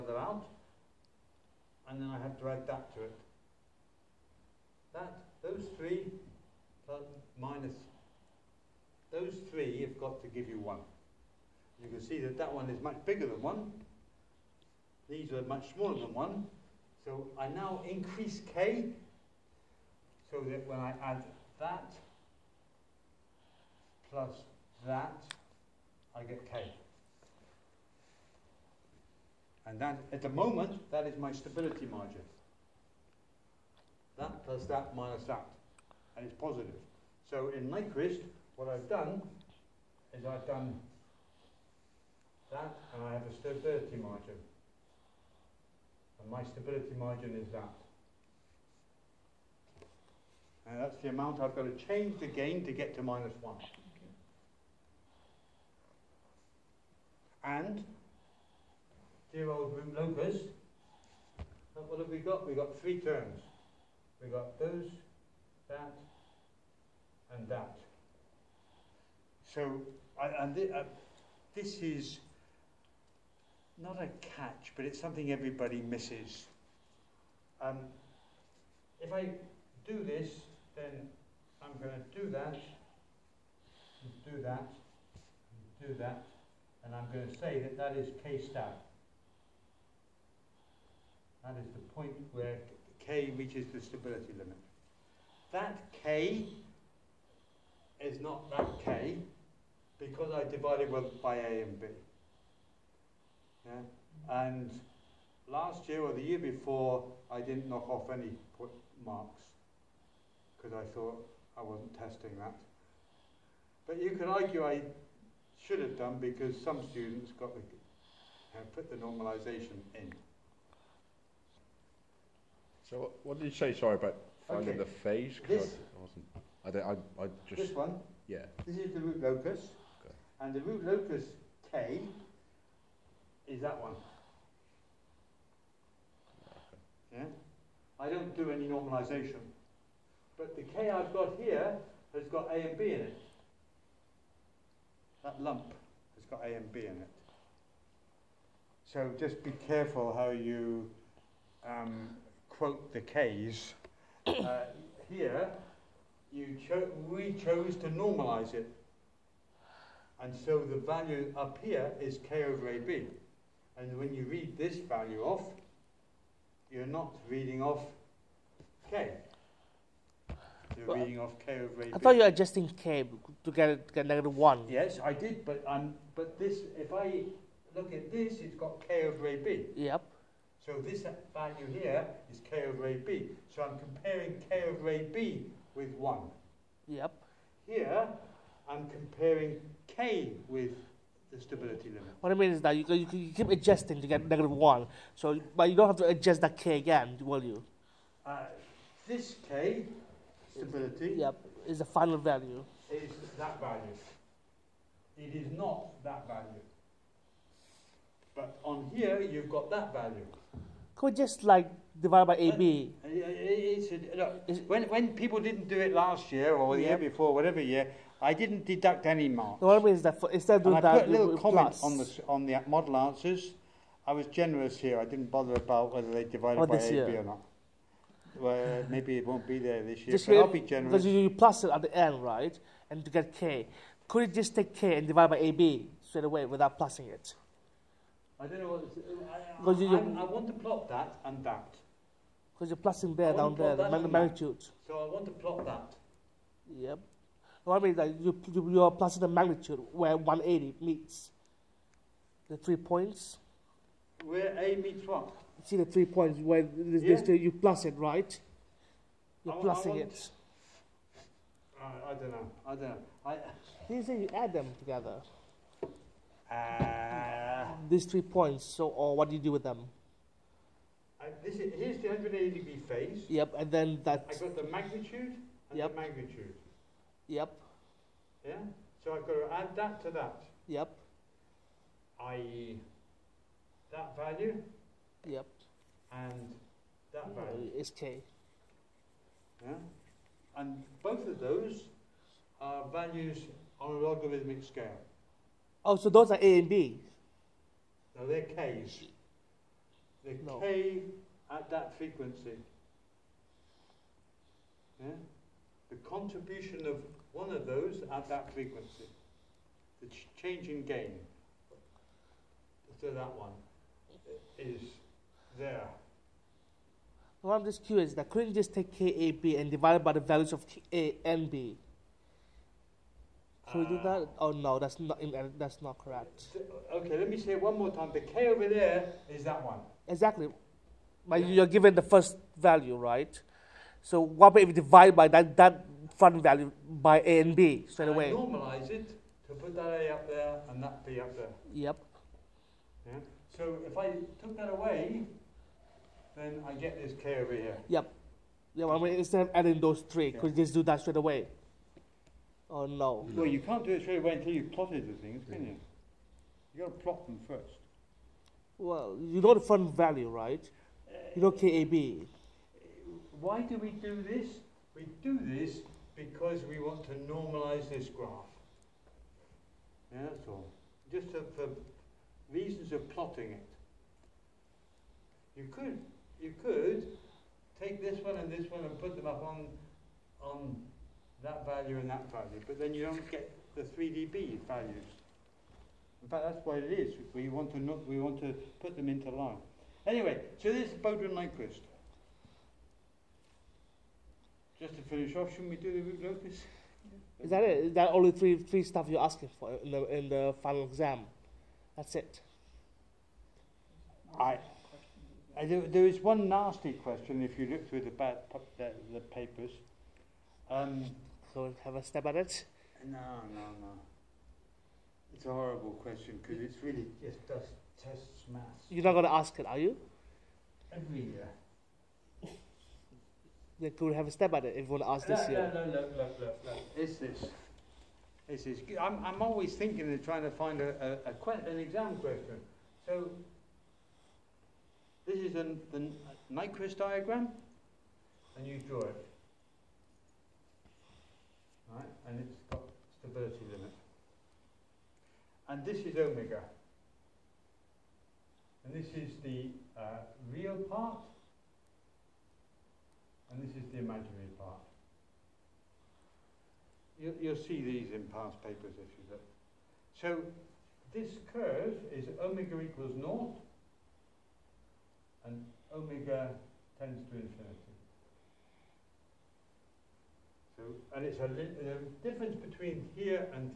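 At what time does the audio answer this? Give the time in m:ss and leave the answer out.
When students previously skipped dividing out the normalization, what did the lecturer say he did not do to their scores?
3:38.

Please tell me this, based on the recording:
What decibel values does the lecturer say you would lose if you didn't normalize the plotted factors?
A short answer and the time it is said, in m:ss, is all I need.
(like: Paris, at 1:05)
3dB values, at 6:23.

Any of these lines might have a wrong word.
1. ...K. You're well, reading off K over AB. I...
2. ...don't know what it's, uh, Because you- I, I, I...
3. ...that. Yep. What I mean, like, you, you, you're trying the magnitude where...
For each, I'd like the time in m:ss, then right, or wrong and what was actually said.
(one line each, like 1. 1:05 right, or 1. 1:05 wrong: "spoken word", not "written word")
1. 2:48 right
2. 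3:58 right
3. 4:05 wrong: "plusing", not "trying".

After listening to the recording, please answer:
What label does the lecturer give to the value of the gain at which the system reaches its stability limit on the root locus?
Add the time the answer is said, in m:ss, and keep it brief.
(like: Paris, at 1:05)
K star, at 1:28.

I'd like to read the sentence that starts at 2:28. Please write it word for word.
So just be careful how you um, quote the K's, uh, here you cho we chose to normalize it.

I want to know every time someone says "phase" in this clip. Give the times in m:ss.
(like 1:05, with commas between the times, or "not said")
2:04, 4:32.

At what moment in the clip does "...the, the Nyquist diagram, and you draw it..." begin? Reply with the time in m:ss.
7:15.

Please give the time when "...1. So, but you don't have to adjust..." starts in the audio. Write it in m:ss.
3:14.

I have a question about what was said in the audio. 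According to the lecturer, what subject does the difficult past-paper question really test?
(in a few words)
maths.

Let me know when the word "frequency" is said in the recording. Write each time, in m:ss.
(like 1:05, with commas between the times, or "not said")
5:01, 5:08.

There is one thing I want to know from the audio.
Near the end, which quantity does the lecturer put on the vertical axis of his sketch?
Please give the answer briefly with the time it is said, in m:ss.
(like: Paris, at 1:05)
imaginary part, at 7:33.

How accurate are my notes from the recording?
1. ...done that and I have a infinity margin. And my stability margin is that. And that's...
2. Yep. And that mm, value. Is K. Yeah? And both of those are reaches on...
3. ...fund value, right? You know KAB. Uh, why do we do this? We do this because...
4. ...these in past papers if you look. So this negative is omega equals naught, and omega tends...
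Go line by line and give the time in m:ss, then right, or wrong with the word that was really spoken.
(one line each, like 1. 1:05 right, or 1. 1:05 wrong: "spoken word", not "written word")
1. 0:40 wrong: "stability", not "infinity"
2. 4:45 wrong: "values", not "reaches"
3. 5:59 right
4. 7:37 wrong: "curve", not "negative".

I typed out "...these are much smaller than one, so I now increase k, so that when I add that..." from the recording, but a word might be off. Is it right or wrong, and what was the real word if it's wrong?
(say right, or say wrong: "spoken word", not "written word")
right.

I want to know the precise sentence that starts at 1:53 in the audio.
But you could argue I should have done because some students got the, uh, put the normalization in.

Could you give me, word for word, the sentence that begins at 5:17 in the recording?
What I'm just curious that couldn't you just take KAB and divide it by the values of K A and B?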